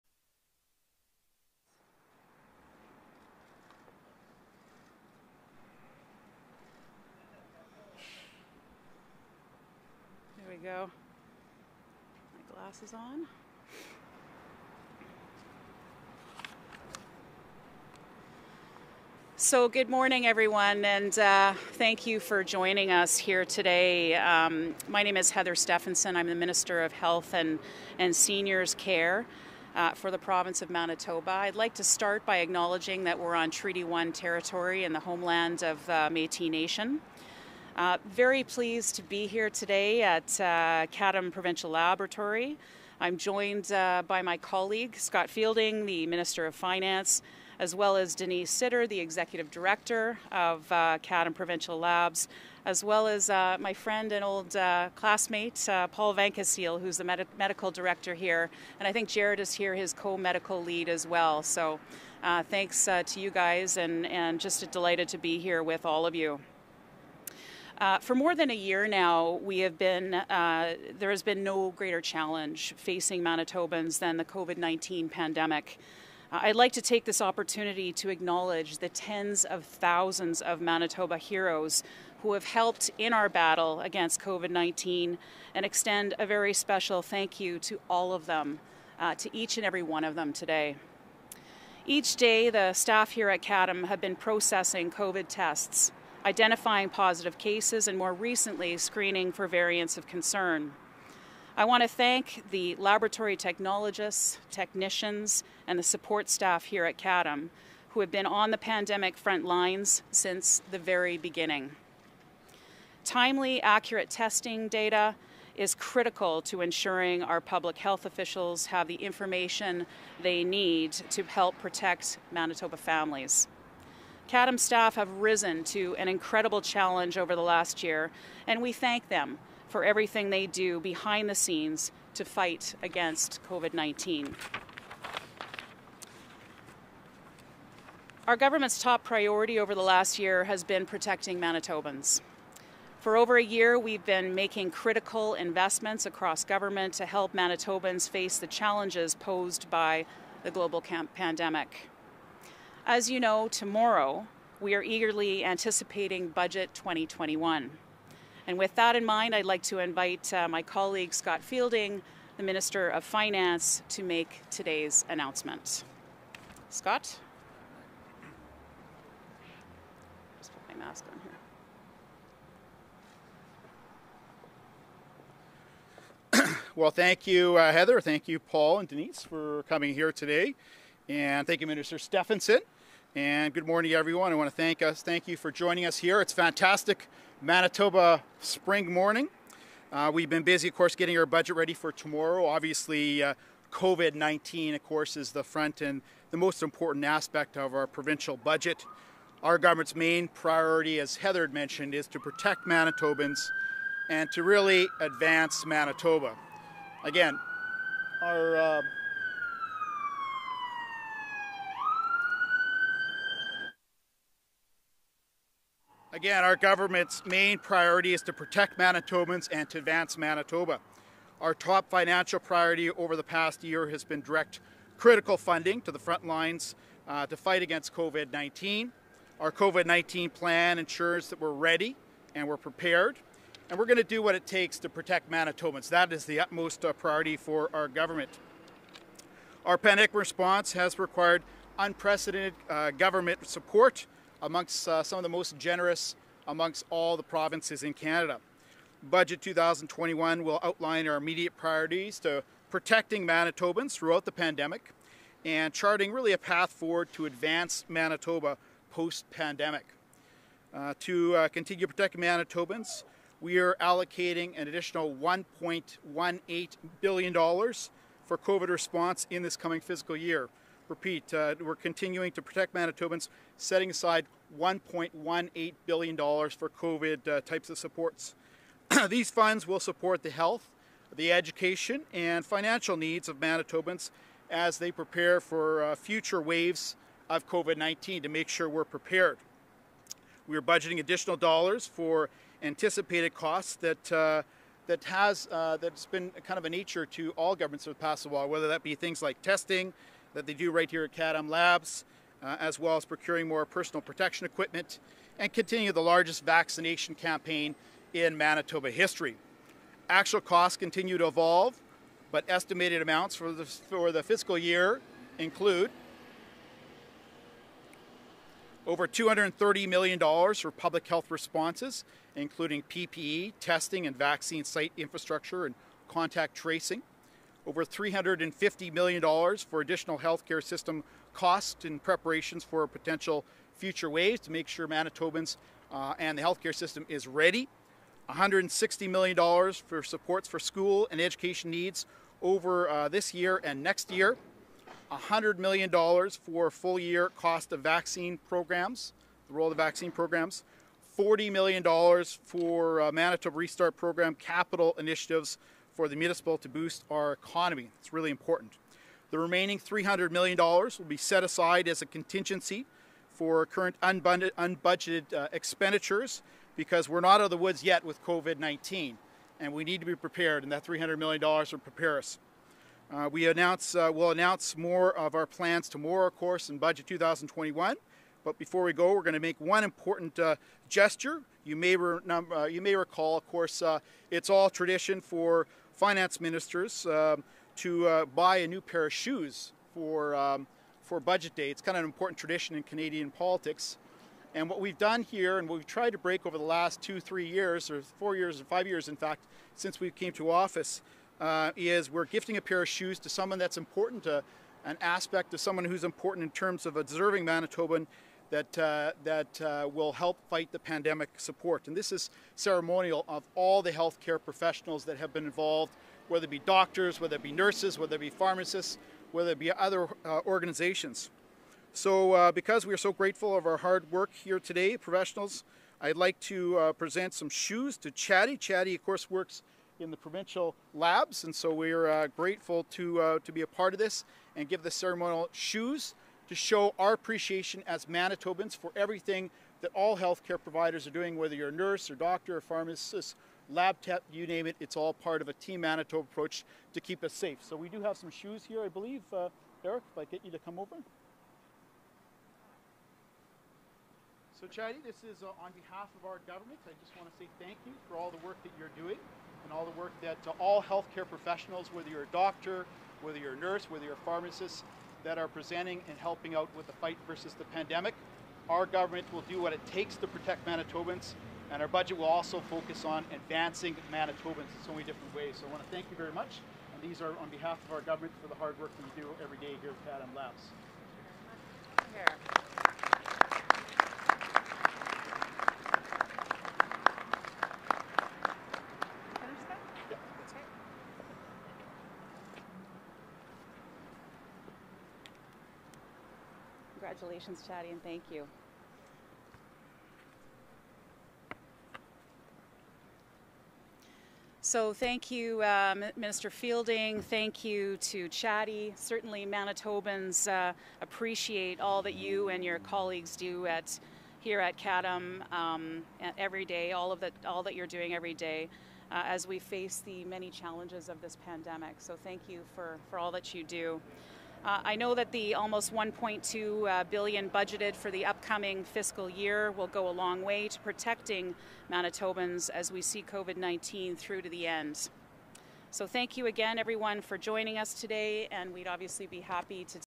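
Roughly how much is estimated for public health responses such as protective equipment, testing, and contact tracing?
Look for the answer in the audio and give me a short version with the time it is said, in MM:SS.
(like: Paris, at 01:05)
over $230 million, at 05:18.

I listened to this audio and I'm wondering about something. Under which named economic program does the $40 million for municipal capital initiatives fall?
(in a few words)
Manitoba Restart Program.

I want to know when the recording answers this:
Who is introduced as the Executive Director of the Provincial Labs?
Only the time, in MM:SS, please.
00:48.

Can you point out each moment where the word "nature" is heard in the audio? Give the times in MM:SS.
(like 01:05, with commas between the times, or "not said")
04:56.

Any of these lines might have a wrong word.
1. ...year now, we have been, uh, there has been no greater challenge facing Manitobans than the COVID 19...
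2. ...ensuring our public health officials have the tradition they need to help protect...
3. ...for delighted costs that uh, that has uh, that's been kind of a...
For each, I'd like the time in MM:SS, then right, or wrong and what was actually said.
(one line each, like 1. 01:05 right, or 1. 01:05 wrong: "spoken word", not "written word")
1. 01:08 right
2. 01:56 wrong: "information", not "tradition"
3. 04:51 wrong: "anticipated", not "delighted".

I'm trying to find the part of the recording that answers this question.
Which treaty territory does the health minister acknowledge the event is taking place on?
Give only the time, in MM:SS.
00:33.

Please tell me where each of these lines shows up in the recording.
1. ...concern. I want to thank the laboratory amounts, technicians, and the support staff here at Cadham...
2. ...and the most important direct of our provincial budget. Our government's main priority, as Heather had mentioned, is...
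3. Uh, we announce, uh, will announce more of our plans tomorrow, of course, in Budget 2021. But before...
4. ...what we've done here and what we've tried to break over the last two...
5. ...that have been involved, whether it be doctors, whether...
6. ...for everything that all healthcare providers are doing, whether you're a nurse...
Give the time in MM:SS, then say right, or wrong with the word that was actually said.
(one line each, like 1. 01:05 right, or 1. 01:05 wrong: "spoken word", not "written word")
1. 01:40 wrong: "technologists", not "amounts"
2. 03:15 wrong: "aspect", not "direct"
3. 06:13 right
4. 06:34 right
5. 06:55 right
6. 07:18 right.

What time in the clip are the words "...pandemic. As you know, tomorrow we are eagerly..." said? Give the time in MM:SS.
02:30.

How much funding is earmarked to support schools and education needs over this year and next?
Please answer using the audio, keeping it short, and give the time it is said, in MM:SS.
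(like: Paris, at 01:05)
$160 million, at 05:38.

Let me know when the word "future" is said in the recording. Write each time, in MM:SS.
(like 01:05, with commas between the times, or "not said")
04:45, 05:33.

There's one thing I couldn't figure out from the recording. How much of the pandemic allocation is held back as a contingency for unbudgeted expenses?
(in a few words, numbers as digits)
$300 million.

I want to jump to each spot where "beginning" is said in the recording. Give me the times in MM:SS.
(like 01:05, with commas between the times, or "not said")
01:51.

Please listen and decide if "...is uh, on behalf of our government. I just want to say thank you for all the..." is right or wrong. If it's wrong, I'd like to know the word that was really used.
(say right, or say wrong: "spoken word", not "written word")
right.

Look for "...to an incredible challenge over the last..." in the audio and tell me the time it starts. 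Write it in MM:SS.
02:05.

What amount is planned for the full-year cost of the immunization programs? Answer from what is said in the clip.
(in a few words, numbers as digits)
$100 million.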